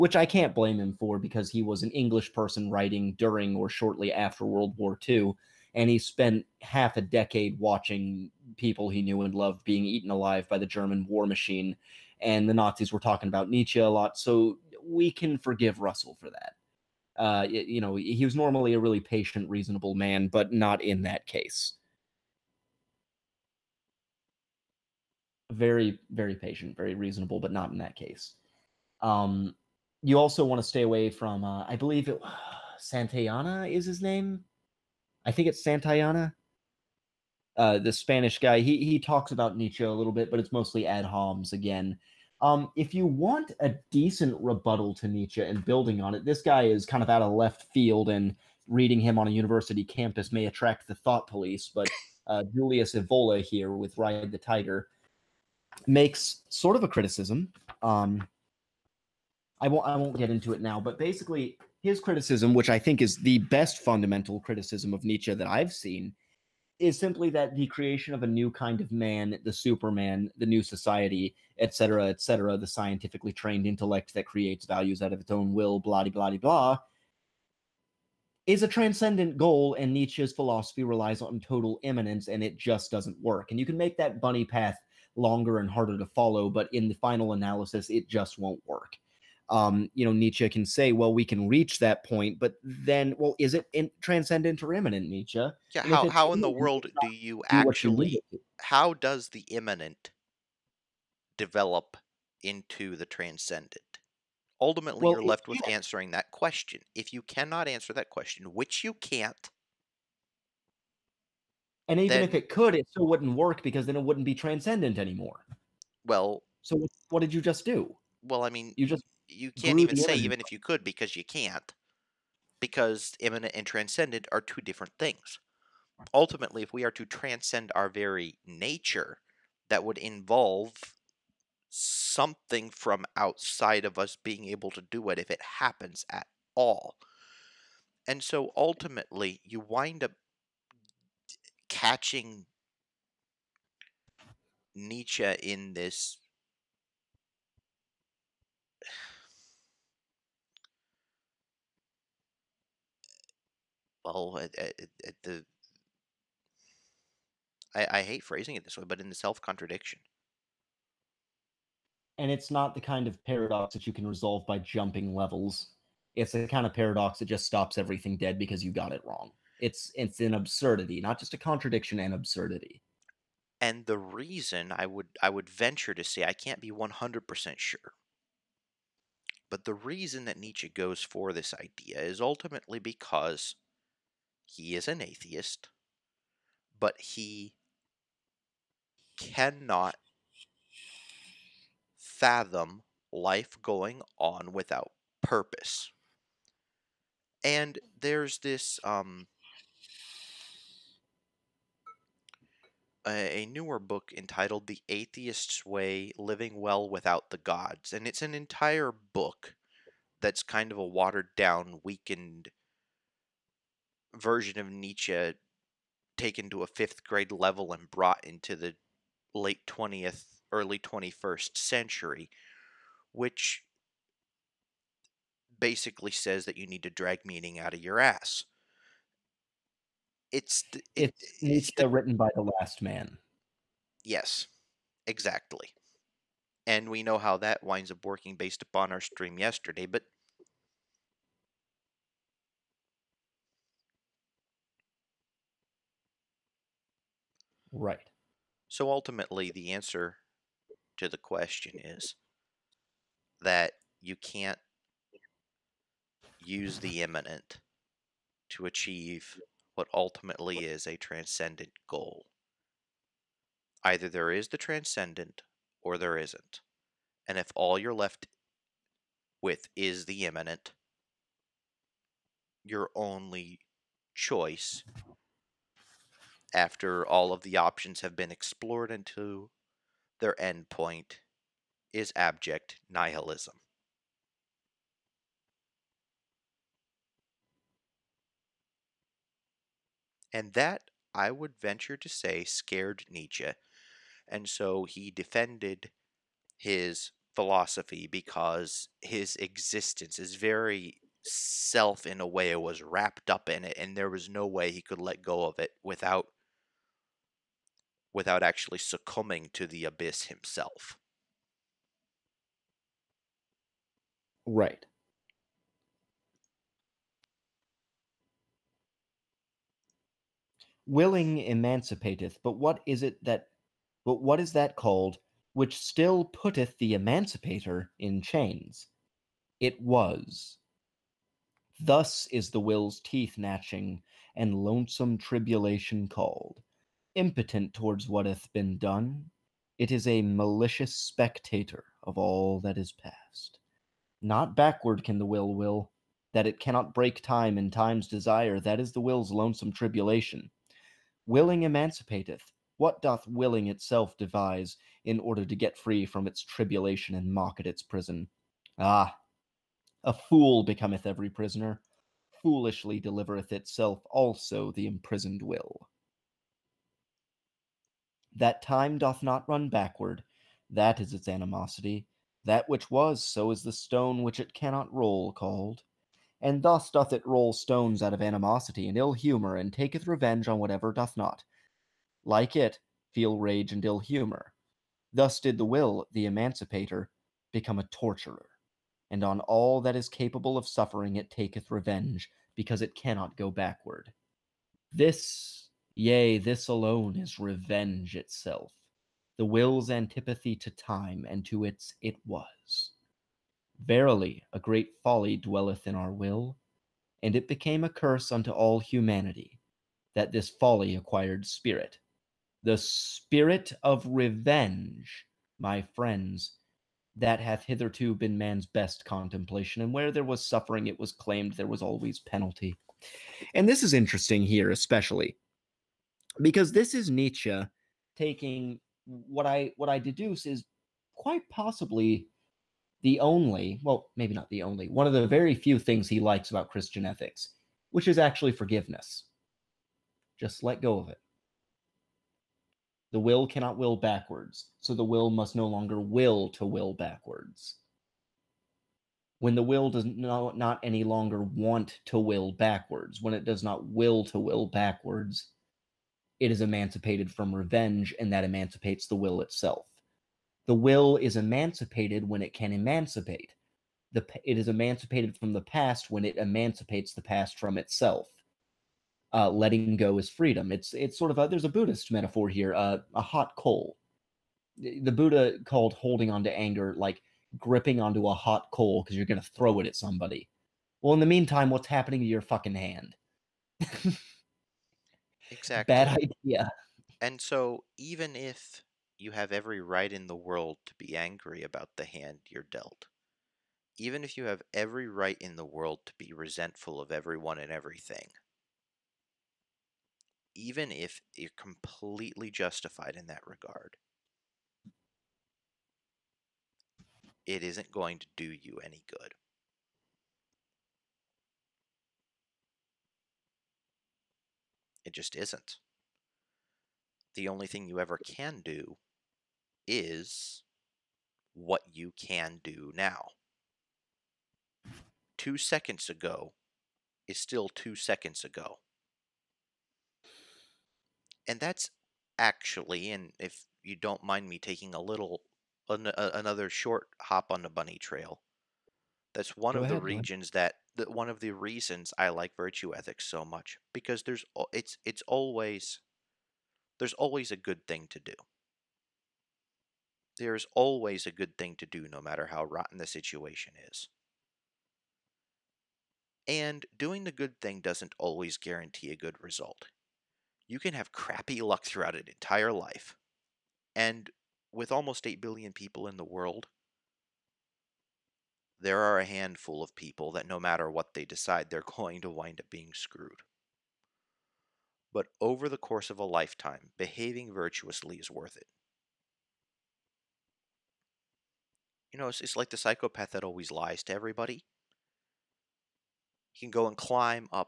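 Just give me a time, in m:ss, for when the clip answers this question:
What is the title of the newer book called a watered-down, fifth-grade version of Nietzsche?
3:24.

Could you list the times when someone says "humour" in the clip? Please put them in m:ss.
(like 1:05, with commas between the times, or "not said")
6:19, 6:23.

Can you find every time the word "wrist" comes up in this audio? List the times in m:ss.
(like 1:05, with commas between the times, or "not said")
not said.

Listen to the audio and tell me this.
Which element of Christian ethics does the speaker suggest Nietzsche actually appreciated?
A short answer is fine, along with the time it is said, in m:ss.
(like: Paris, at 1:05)
forgiveness, at 7:18.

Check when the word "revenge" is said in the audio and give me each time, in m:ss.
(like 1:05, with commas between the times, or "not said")
6:20, 6:31, 6:37, 6:54, 7:37.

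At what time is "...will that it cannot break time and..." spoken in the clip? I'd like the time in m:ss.
5:45.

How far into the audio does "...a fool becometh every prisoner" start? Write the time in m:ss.
6:00.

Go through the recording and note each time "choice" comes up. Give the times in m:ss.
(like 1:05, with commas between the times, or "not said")
4:34.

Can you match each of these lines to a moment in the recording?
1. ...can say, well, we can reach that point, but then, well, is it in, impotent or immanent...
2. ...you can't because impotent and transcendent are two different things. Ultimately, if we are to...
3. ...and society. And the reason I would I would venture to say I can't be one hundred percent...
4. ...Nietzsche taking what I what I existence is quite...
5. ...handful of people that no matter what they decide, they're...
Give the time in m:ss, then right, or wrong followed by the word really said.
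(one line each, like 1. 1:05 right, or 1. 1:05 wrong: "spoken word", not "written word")
1. 1:30 wrong: "transcendent", not "impotent"
2. 2:01 wrong: "immanent", not "impotent"
3. 2:51 wrong: "absurdity", not "society"
4. 7:07 wrong: "deduce", not "existence"
5. 9:29 right.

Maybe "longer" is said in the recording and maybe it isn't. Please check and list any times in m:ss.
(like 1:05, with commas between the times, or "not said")
1:25, 7:25, 7:31.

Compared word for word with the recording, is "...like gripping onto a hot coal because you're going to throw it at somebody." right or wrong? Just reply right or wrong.
right.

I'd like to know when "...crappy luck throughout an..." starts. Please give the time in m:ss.
9:21.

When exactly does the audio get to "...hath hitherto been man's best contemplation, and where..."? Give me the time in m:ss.
6:57.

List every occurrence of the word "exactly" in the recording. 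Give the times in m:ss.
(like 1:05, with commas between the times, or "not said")
3:55, 8:05.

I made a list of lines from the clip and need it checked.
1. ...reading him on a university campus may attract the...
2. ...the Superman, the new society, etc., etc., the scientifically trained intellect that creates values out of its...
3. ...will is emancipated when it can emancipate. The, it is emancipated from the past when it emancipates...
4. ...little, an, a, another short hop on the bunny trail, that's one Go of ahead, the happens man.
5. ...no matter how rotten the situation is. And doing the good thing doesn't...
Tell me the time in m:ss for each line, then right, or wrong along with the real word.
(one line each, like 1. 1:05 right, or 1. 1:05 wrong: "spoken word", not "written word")
1. 0:48 right
2. 1:09 right
3. 7:40 right
4. 8:55 wrong: "regions", not "happens"
5. 9:12 right.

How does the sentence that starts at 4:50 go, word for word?
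And that, I would venture to say, scared Nietzsche.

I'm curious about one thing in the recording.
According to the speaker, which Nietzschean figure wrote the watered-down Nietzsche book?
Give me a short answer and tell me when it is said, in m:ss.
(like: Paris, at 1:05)
the last man, at 3:52.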